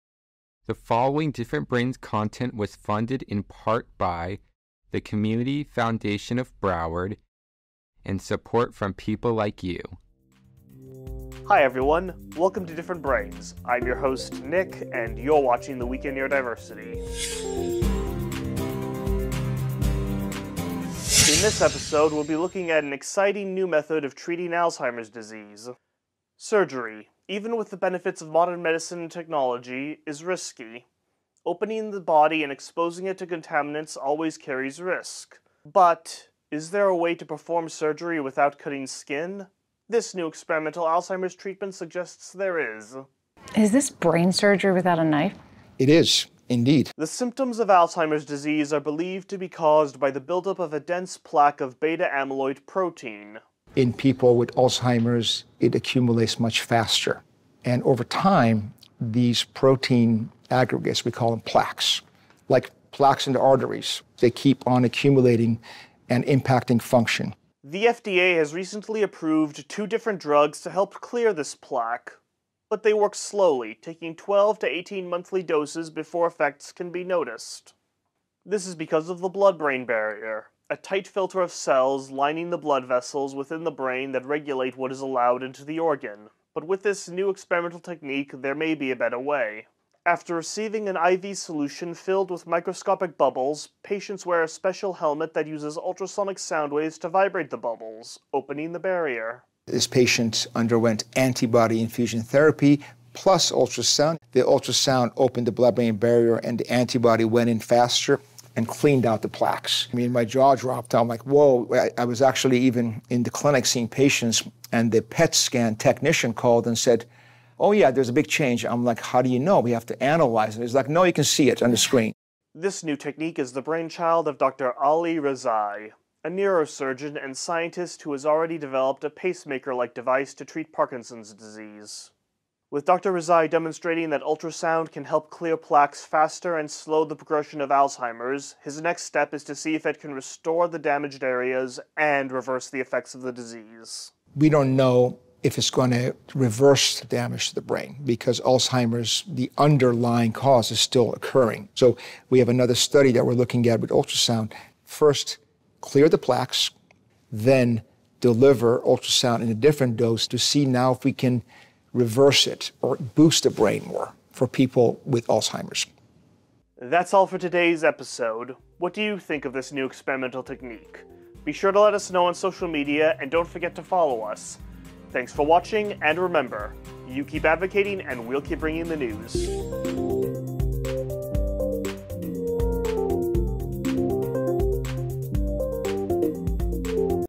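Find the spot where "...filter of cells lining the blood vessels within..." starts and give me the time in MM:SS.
01:21.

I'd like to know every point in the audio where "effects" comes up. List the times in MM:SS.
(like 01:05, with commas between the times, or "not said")
01:16, 02:22.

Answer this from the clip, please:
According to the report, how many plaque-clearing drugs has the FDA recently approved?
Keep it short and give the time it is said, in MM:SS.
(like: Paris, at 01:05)
2, at 01:09.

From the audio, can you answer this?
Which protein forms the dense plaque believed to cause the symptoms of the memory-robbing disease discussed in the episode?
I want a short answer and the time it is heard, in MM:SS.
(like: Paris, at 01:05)
Beta amyloid, at 00:51.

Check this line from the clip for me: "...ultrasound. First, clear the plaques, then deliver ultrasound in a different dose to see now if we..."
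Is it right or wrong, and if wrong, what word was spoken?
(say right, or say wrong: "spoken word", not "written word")
right.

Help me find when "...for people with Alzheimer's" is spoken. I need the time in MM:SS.
02:44.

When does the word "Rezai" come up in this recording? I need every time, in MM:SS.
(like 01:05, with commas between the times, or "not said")
02:05, 02:13.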